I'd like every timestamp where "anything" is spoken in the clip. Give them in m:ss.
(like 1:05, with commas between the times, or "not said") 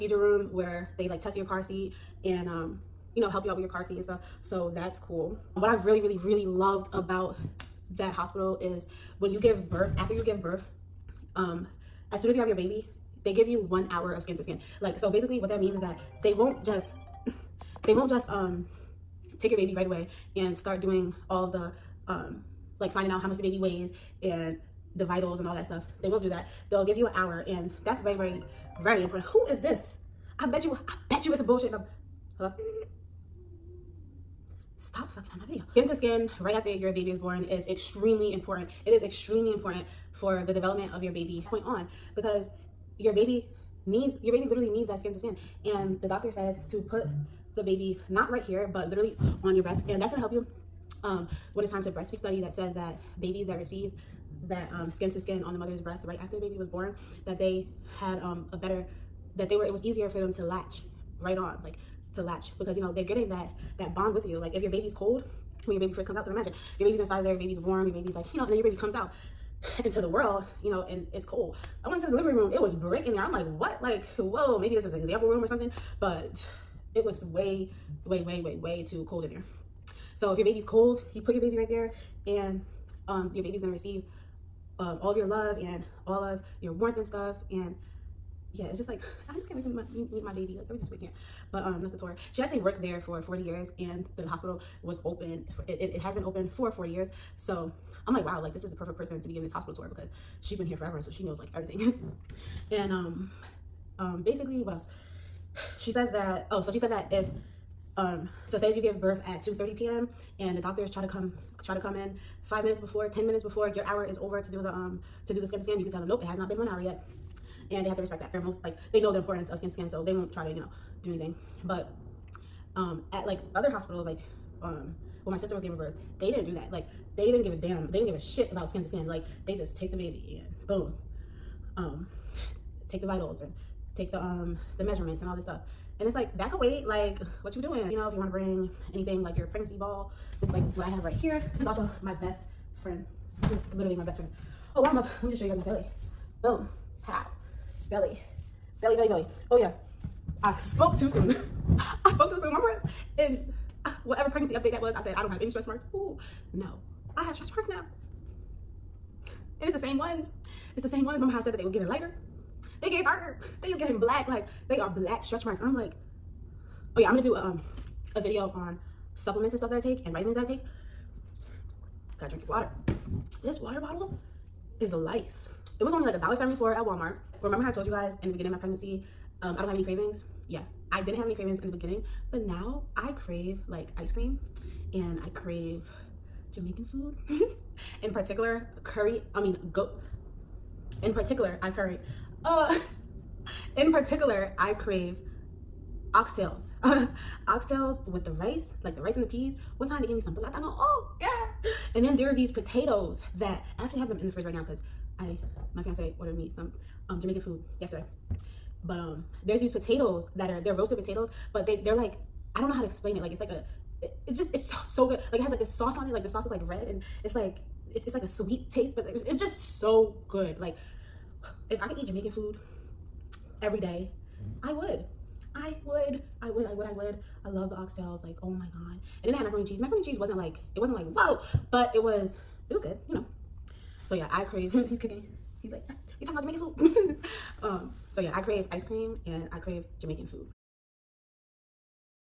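2:01, 2:18.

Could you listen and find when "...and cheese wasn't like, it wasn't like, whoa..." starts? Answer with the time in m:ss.
3:49.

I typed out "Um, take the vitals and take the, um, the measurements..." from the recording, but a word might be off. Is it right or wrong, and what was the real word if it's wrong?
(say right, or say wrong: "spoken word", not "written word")
right.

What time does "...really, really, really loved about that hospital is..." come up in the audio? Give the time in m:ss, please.
0:05.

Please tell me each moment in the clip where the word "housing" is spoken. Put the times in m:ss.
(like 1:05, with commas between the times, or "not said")
not said.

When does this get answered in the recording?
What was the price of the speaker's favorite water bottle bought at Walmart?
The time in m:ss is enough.
2:56.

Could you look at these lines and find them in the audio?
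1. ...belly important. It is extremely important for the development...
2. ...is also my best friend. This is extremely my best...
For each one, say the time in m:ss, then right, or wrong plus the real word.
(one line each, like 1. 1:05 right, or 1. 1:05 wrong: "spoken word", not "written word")
1. 0:37 wrong: "extremely", not "belly"
2. 2:21 wrong: "literally", not "extremely".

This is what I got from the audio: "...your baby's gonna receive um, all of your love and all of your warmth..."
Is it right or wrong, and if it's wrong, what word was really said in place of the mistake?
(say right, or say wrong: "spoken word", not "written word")
right.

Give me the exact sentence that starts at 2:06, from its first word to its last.
Like they didn't give a damn.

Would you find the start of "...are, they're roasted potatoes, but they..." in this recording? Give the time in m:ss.
3:30.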